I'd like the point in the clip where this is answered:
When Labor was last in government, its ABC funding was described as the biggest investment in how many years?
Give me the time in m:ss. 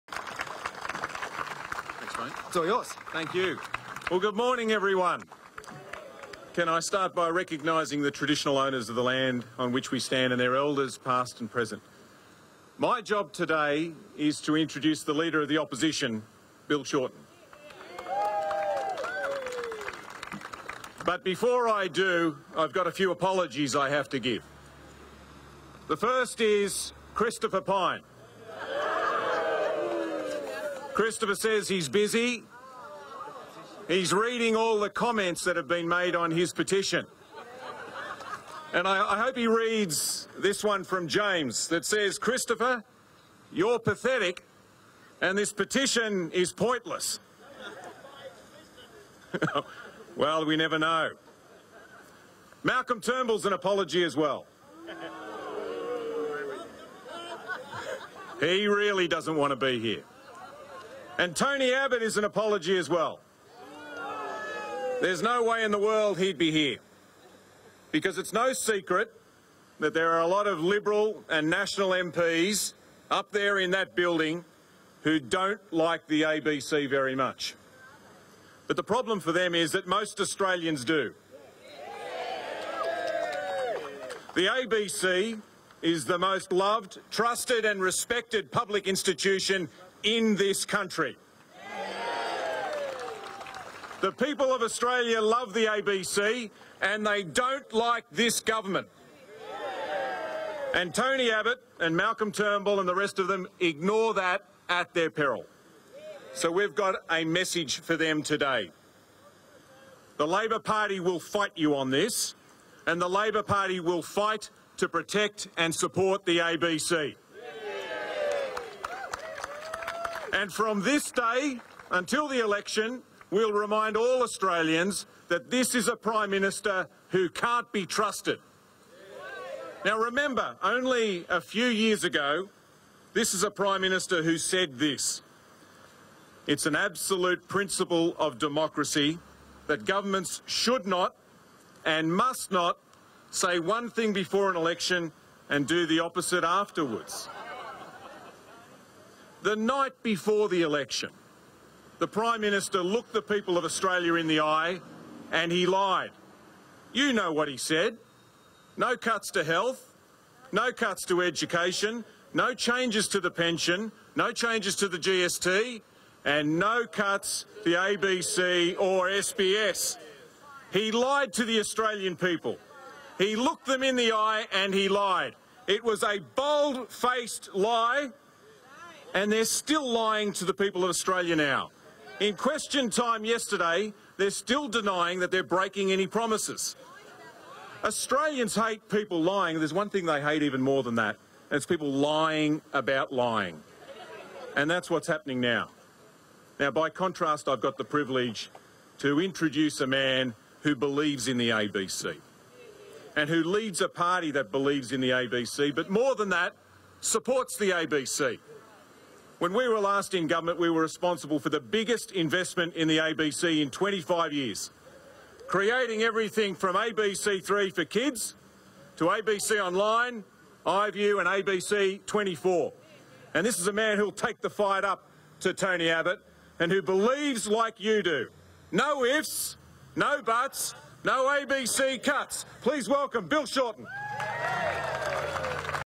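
3:33.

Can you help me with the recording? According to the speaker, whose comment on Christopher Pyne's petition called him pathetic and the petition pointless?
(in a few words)
James.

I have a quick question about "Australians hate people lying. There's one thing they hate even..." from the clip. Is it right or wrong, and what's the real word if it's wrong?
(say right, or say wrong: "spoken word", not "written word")
right.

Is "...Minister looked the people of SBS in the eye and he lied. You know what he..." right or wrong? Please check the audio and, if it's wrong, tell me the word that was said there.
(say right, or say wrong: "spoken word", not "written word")
wrong: "Australia", not "SBS".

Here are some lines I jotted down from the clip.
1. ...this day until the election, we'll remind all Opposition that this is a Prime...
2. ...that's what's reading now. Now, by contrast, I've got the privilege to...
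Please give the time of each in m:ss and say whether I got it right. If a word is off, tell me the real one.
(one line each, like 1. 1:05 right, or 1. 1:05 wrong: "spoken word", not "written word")
1. 2:00 wrong: "Australians", not "Opposition"
2. 3:14 wrong: "happening", not "reading".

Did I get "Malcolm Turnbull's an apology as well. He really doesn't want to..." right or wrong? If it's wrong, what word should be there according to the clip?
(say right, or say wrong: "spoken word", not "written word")
right.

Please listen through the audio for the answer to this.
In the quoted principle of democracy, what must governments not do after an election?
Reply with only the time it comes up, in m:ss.
2:25.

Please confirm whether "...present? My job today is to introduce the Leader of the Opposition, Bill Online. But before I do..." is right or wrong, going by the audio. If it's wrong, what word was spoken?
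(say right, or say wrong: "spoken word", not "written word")
wrong: "Shorten", not "Online".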